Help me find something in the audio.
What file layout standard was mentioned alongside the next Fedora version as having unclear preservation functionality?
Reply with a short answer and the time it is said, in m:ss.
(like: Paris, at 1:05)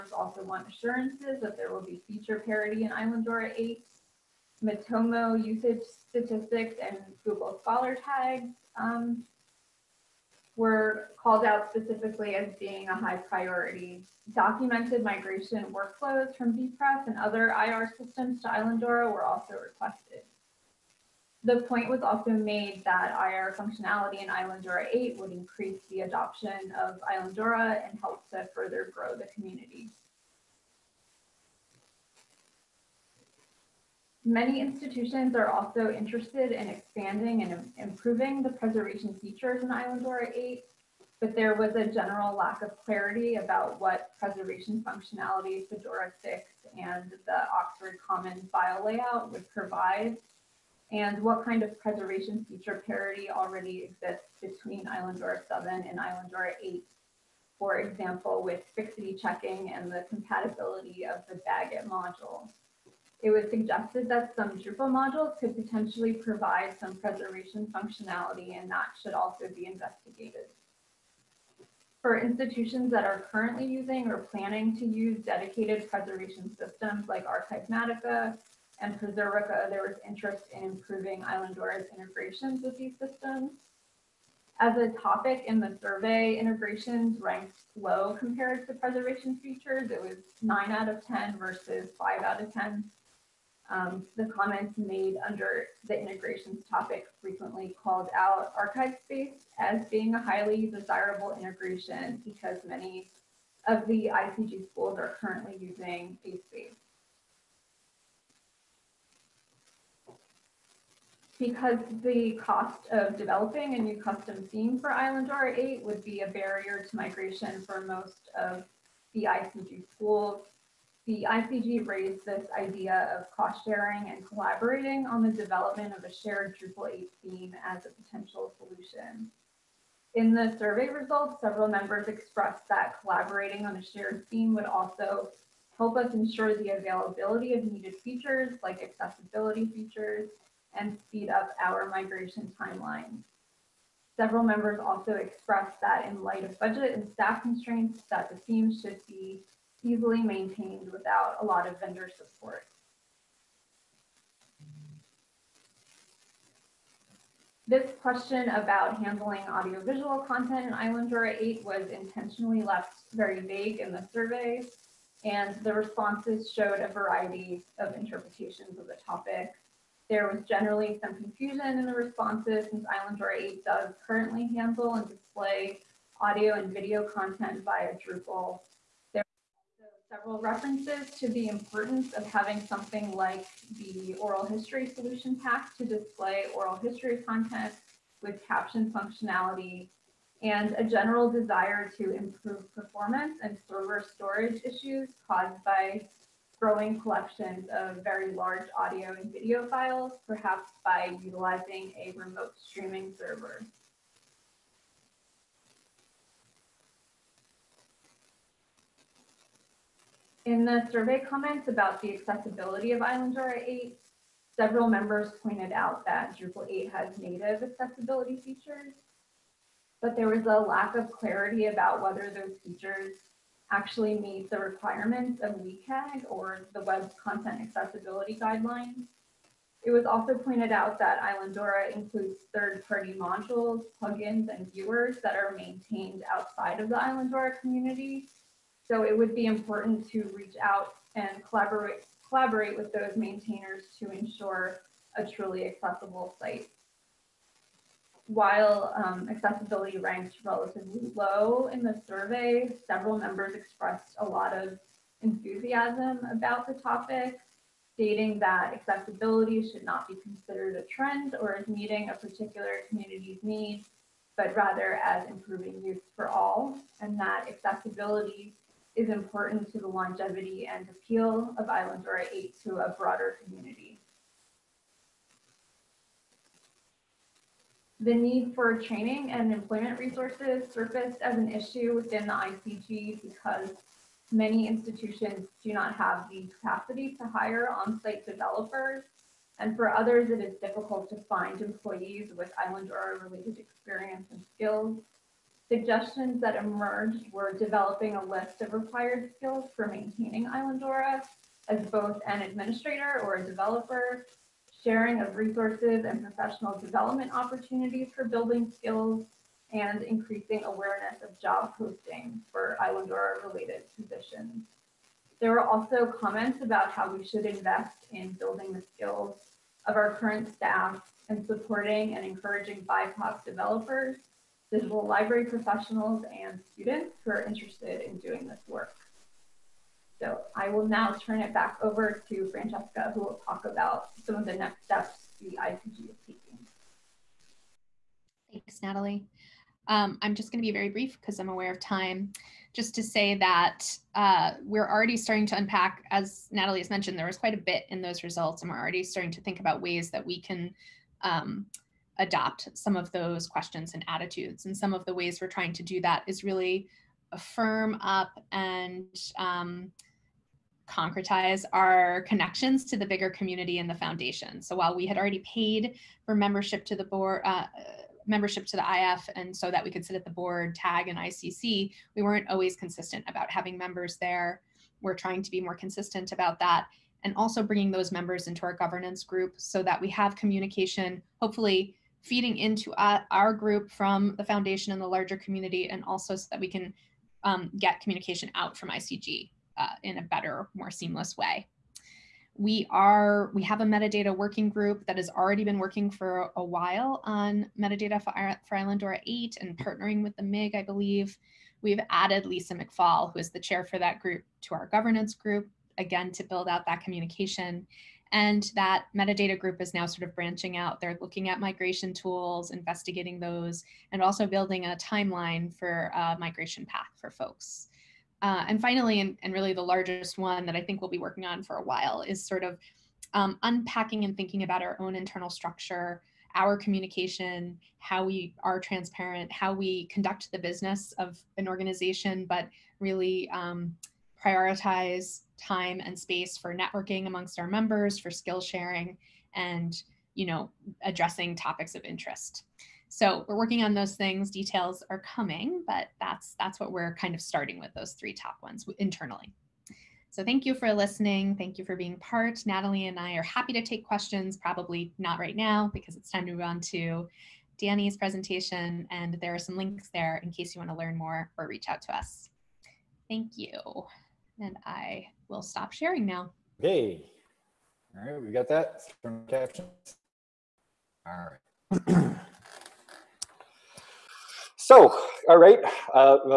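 Oxford Commons, at 0:47.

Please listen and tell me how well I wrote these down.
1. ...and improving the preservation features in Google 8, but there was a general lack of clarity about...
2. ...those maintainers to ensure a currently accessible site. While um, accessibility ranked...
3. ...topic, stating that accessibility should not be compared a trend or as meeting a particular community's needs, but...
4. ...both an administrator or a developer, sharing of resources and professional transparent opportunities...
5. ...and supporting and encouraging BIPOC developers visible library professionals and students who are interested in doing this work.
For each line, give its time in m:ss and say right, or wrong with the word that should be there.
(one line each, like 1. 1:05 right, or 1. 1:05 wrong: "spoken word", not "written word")
1. 0:37 wrong: "Islandora", not "Google"
2. 4:02 wrong: "truly", not "currently"
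3. 4:16 wrong: "considered", not "compared"
4. 5:01 wrong: "development", not "transparent"
5. 5:21 right.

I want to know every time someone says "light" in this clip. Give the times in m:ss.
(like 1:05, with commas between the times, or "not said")
2:26.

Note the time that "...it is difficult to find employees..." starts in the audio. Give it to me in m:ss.
4:50.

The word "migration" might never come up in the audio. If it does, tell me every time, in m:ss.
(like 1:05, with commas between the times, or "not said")
0:15, 1:56, 2:21, 6:51, 6:56.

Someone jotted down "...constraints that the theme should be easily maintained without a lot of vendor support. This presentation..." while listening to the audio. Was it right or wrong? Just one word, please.
wrong.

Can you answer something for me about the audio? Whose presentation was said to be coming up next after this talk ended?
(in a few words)
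Danny.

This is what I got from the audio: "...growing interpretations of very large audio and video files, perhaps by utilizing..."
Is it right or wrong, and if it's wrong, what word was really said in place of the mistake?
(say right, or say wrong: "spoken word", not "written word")
wrong: "collections", not "interpretations".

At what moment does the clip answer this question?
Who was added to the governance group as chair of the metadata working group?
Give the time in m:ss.
6:42.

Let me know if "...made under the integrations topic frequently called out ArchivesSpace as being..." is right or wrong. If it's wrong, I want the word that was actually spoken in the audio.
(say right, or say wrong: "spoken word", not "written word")
right.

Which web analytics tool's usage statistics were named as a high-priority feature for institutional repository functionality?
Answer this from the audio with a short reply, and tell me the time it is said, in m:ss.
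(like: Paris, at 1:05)
Matomo, at 0:04.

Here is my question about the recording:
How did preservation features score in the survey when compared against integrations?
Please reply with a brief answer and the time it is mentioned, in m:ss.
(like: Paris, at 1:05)
9 out of 10, at 1:30.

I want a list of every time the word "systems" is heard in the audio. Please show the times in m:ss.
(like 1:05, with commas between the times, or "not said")
0:17, 1:16, 1:22.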